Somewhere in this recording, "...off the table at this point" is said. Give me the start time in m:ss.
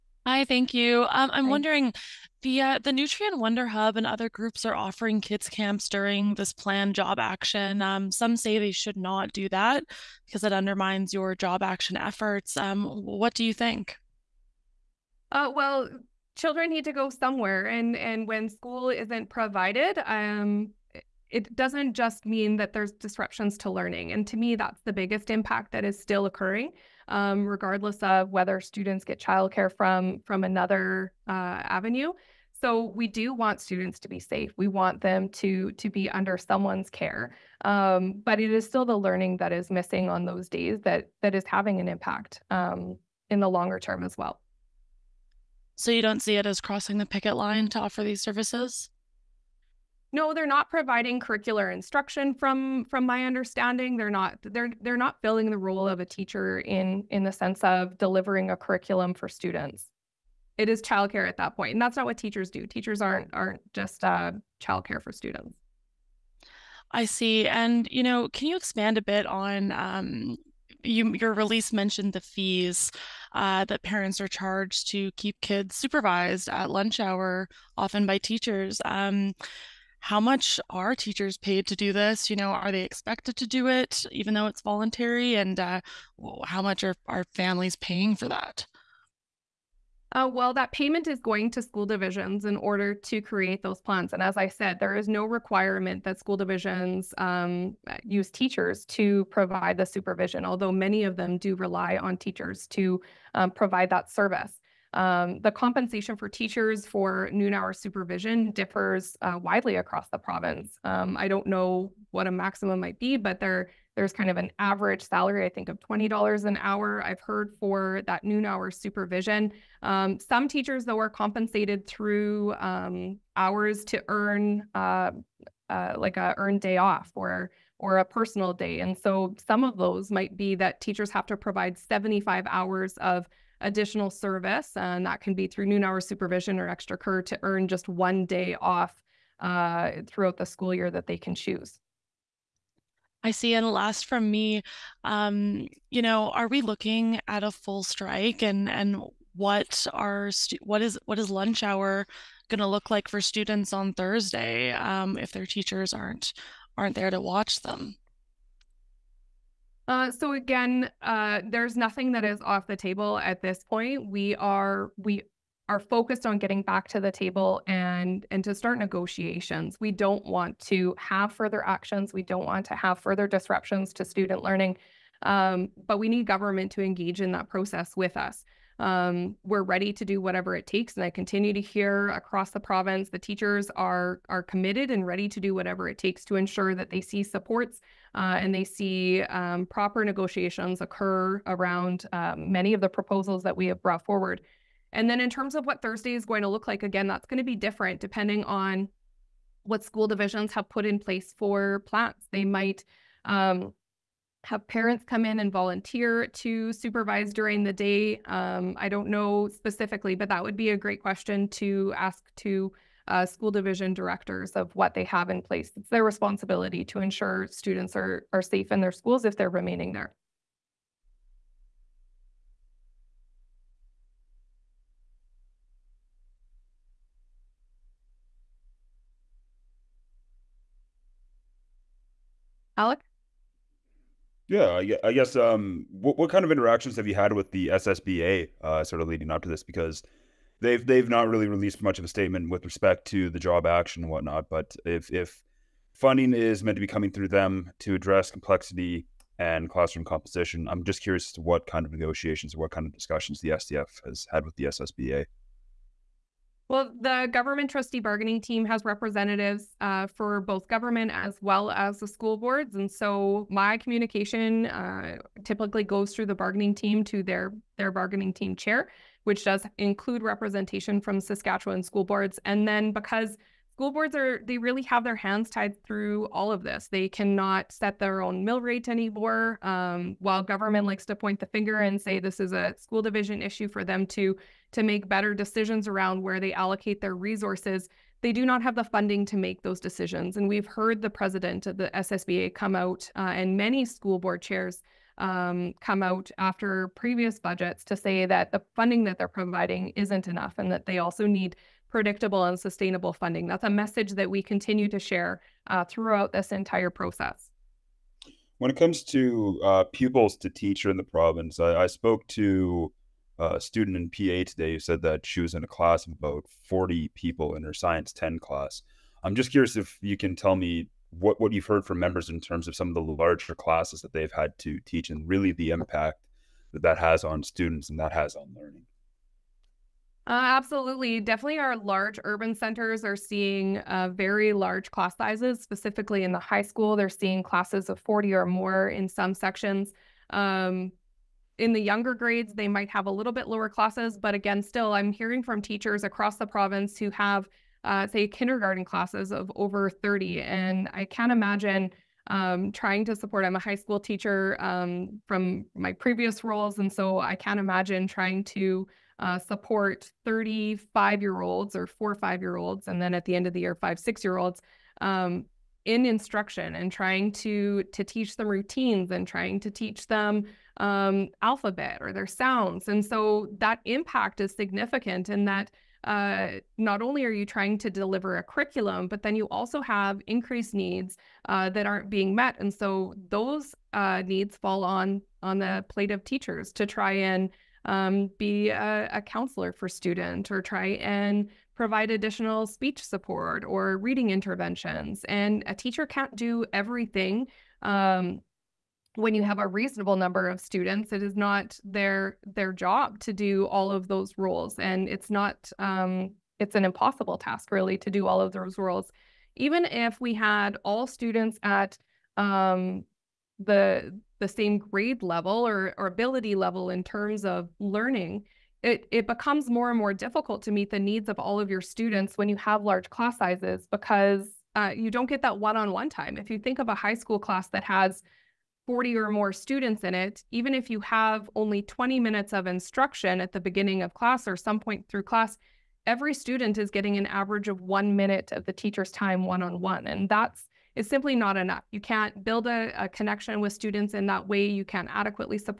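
2:42.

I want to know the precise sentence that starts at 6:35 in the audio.
And a teacher can't do everything.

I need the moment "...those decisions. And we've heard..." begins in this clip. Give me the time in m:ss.
4:49.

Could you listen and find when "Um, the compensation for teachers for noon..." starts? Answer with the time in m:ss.
1:44.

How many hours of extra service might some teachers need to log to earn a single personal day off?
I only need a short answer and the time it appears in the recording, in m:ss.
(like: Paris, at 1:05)
75 hours, at 2:11.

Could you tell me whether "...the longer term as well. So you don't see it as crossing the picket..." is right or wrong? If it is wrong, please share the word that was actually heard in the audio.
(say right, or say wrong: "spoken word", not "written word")
right.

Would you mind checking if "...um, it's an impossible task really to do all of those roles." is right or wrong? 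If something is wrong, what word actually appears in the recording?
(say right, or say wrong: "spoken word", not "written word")
right.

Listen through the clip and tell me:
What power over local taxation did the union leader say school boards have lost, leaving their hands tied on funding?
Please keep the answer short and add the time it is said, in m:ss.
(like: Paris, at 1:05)
mill rate, at 4:38.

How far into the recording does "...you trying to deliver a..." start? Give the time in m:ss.
6:17.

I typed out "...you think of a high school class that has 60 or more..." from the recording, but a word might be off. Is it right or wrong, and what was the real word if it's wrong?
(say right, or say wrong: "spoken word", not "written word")
wrong: "40", not "60".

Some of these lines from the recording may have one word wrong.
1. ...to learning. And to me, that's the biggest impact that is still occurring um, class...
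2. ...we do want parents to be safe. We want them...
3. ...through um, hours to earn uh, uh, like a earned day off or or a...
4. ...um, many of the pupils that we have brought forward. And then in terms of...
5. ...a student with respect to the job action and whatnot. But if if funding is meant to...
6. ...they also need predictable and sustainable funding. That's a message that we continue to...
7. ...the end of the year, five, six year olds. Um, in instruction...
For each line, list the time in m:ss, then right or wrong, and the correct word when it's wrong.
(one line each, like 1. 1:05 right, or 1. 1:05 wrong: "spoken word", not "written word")
1. 0:23 wrong: "regardless", not "class"
2. 0:32 wrong: "students", not "parents"
3. 2:01 right
4. 3:12 wrong: "proposals", not "pupils"
5. 4:02 wrong: "statement", not "student"
6. 5:00 right
7. 6:03 right.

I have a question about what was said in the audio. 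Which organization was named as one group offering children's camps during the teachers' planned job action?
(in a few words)
Nutrien Wonderhub.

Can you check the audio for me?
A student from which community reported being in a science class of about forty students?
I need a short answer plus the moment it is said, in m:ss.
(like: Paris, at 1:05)
PA, at 5:14.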